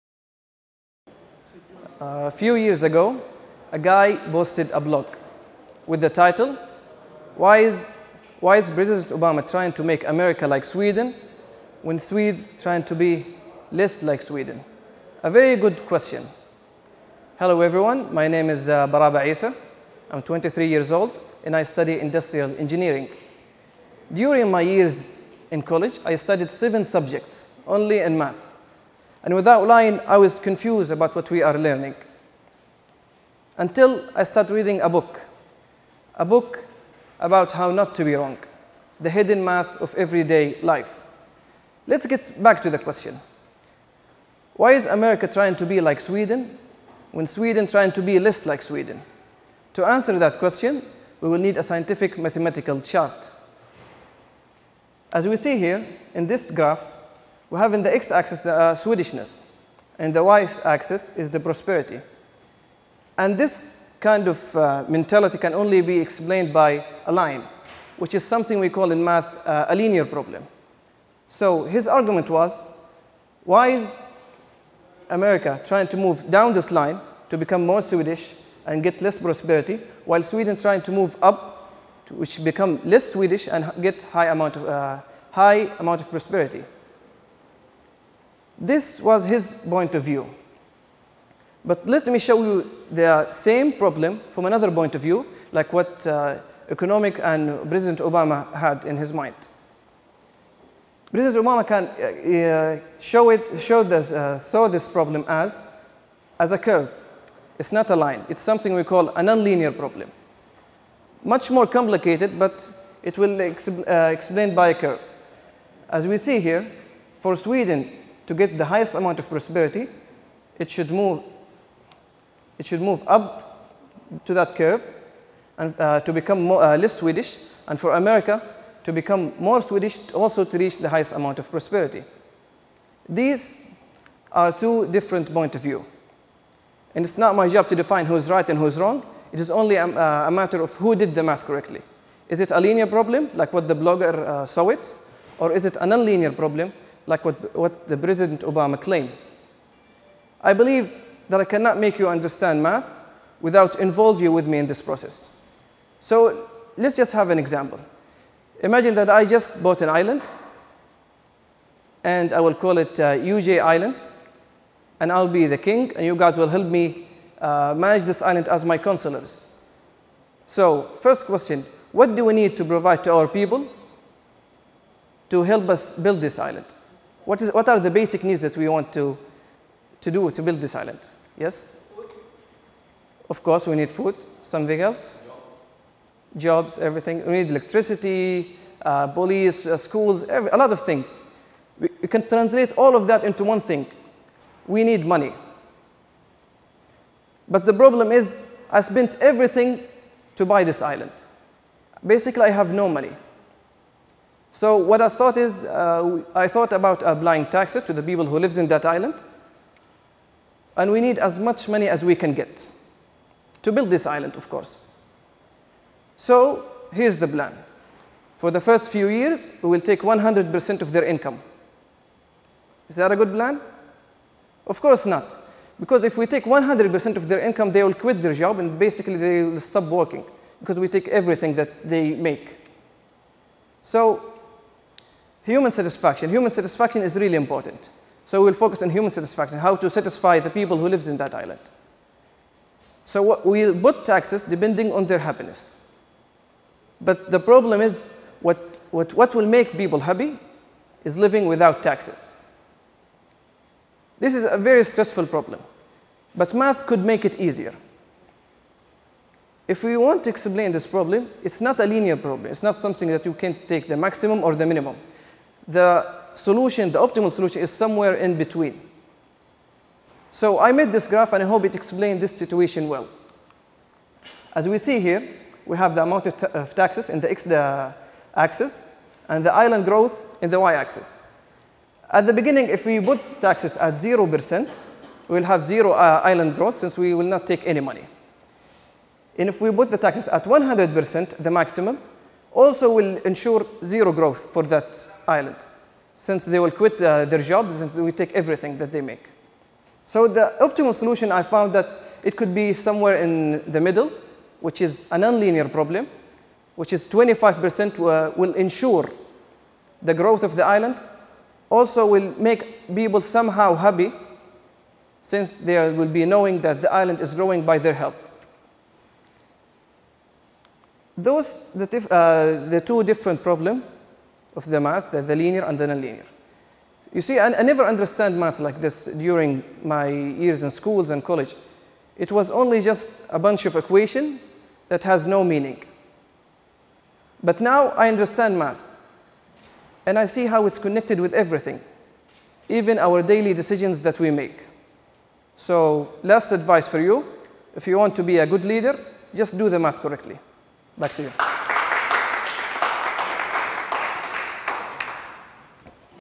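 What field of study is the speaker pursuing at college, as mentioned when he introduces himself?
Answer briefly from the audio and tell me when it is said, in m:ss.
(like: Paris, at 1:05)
industrial engineering, at 0:21.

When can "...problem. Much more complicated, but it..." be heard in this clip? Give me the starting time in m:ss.
1:49.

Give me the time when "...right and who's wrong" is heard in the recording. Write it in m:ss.
2:18.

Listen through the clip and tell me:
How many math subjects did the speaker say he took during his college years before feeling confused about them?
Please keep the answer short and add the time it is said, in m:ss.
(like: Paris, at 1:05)
7, at 0:26.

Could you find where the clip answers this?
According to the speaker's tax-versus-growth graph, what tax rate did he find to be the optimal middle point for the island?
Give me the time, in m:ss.
5:07.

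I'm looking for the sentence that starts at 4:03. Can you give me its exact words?
So we'll put taxes depending on their happiness.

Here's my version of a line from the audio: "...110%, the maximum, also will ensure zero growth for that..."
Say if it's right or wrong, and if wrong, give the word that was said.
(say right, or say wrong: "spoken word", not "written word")
wrong: "100", not "110".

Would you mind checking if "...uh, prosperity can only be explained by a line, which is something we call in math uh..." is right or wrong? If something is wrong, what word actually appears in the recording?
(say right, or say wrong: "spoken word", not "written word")
wrong: "mentality", not "prosperity".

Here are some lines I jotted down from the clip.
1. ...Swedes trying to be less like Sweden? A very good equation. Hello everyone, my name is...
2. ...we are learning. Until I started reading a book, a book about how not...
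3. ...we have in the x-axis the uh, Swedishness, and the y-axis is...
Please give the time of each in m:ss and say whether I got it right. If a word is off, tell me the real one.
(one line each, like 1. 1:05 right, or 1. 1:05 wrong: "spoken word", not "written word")
1. 0:11 wrong: "question", not "equation"
2. 0:31 right
3. 0:57 right.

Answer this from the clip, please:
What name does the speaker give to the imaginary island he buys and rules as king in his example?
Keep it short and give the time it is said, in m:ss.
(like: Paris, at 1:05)
UJ Island, at 2:43.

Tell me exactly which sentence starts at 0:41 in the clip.
Let's get back to the question.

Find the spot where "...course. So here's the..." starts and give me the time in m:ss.
3:34.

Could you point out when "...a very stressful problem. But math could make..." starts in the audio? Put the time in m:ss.
4:14.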